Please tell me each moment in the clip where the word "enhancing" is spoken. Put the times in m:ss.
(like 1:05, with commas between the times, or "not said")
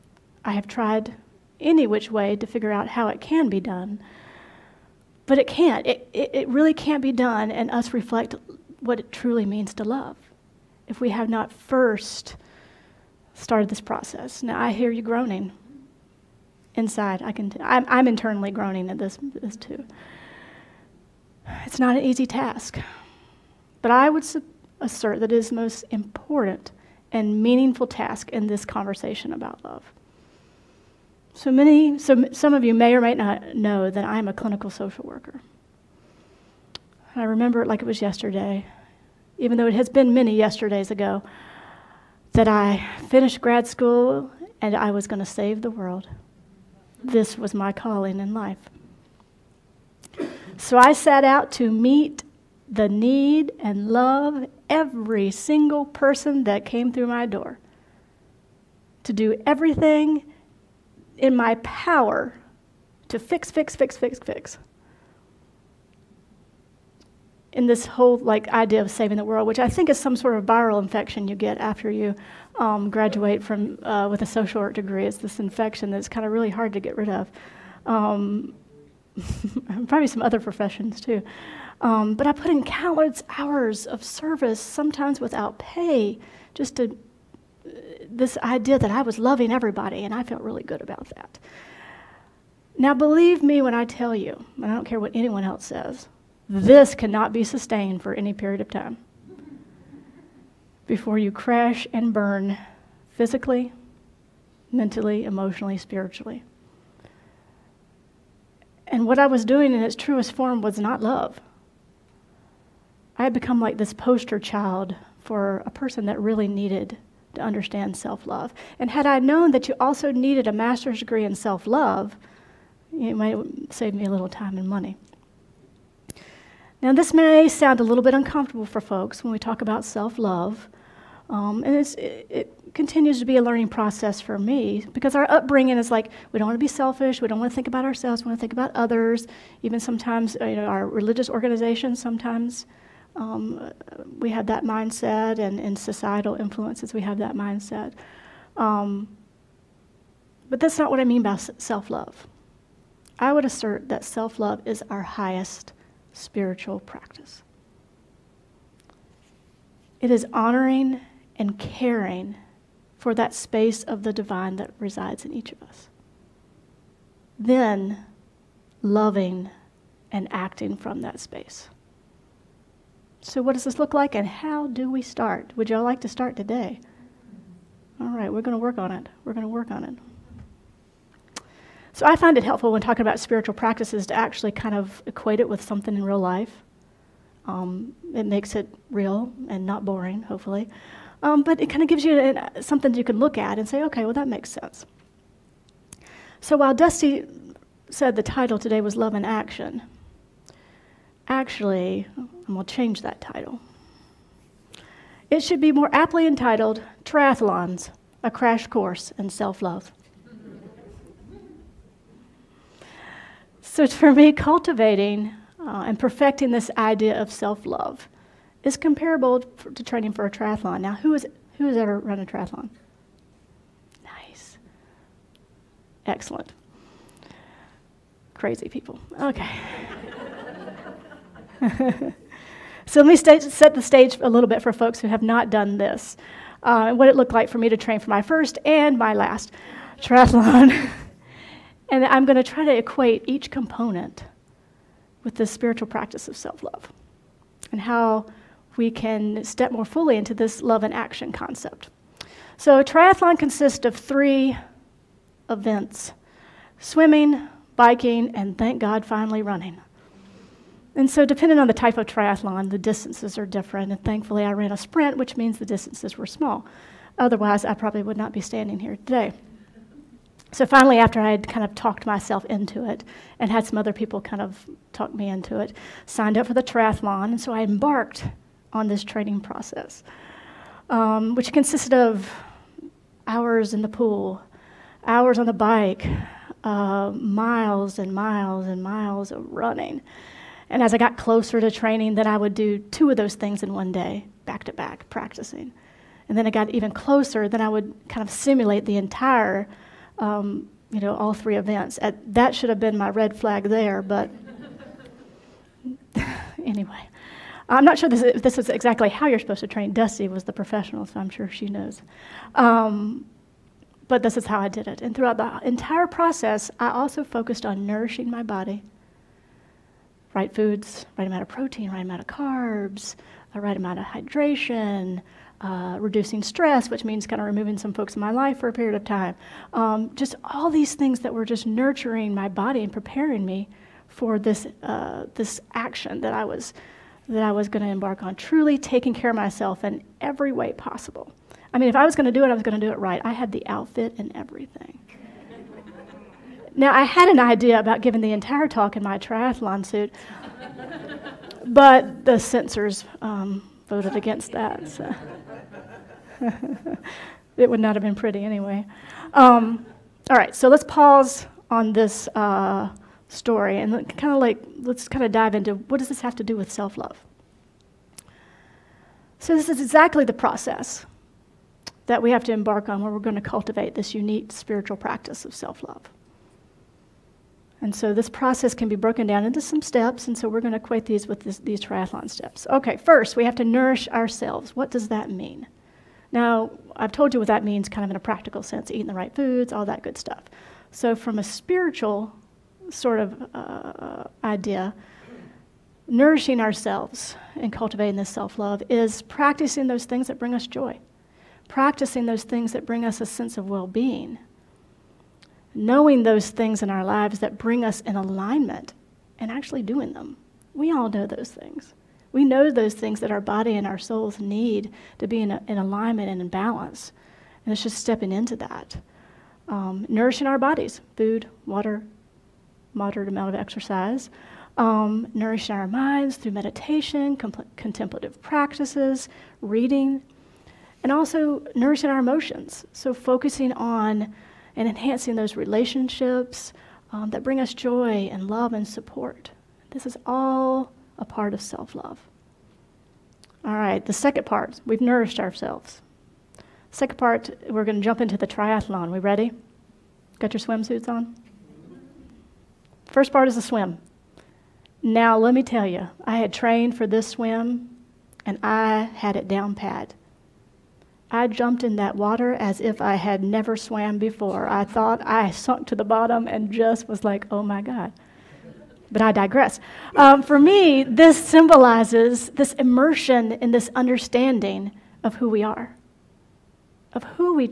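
7:14.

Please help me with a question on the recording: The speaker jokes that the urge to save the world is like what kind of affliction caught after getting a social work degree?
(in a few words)
viral infection.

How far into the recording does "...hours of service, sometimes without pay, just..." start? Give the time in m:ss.
1:23.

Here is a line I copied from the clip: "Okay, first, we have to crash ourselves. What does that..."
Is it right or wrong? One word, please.
wrong.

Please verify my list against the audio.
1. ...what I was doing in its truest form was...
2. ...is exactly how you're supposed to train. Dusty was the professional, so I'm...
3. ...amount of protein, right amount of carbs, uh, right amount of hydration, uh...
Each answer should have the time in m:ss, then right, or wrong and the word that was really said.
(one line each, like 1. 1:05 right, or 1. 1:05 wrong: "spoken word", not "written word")
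1. 1:49 right
2. 5:08 right
3. 5:21 right.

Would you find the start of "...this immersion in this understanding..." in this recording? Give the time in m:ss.
7:52.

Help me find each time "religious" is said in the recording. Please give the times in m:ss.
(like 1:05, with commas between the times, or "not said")
2:20.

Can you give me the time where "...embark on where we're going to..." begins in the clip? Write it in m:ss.
6:12.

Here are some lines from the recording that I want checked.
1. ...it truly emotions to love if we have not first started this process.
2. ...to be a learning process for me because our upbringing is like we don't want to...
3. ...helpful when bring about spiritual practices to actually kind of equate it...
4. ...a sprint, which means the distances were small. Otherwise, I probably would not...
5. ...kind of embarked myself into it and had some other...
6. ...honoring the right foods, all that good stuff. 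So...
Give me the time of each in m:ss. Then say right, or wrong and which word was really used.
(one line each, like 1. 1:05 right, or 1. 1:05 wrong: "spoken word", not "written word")
1. 0:08 wrong: "means", not "emotions"
2. 2:13 right
3. 3:02 wrong: "talking", not "bring"
4. 4:24 right
5. 4:31 wrong: "talked", not "embarked"
6. 6:28 wrong: "eating", not "honoring".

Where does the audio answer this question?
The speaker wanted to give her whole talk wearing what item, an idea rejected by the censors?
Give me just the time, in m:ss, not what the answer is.
5:49.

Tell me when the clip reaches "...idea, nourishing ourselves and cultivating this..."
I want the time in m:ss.
6:34.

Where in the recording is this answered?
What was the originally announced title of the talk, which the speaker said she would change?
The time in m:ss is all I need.
3:18.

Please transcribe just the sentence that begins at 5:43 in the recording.
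I had the outfit and everything.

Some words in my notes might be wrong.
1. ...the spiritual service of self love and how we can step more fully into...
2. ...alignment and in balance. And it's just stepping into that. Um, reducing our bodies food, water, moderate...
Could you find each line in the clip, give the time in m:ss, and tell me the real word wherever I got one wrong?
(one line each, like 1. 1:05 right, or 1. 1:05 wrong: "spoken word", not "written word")
1. 4:05 wrong: "practice", not "service"
2. 6:55 wrong: "nourishing", not "reducing".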